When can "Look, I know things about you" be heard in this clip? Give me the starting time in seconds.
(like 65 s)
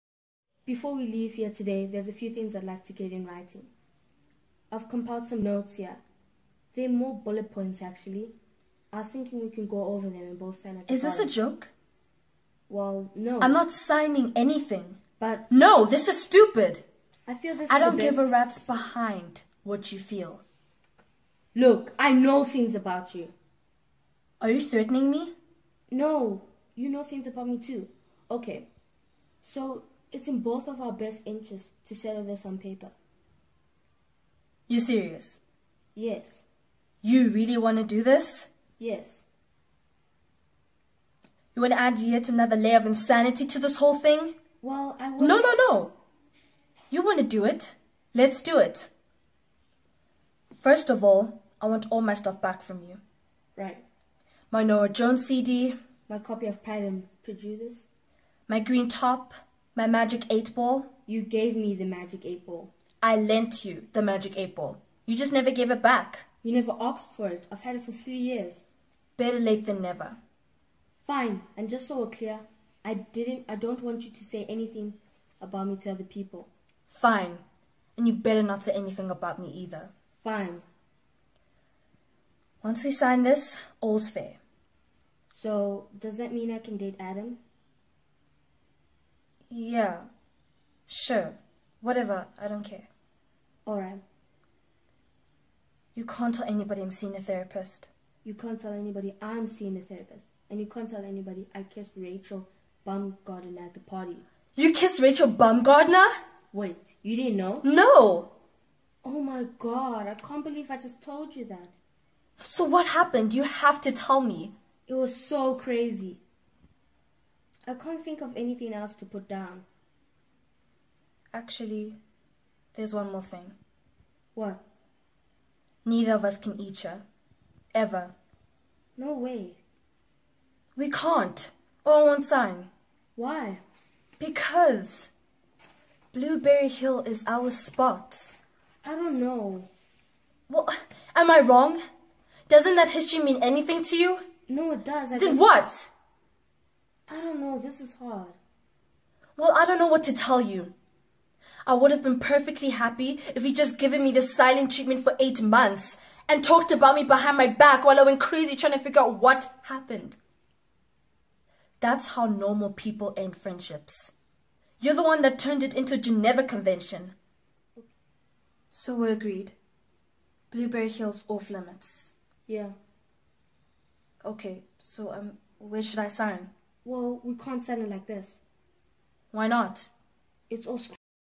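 21 s.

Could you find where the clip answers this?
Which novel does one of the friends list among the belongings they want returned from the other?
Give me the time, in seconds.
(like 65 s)
56 s.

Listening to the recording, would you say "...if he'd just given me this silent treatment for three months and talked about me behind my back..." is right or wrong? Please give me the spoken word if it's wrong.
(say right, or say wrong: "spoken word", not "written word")
wrong: "eight", not "three".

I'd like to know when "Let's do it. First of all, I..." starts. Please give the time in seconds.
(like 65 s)
48 s.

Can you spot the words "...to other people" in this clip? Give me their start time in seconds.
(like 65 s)
75 s.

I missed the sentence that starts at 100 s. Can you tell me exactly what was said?
And you can't tell anybody I kissed Rachel Baumgardner at the party.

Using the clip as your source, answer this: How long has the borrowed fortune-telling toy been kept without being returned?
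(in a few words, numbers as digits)
3 years.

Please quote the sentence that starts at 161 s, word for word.
That's how normal people end friendships.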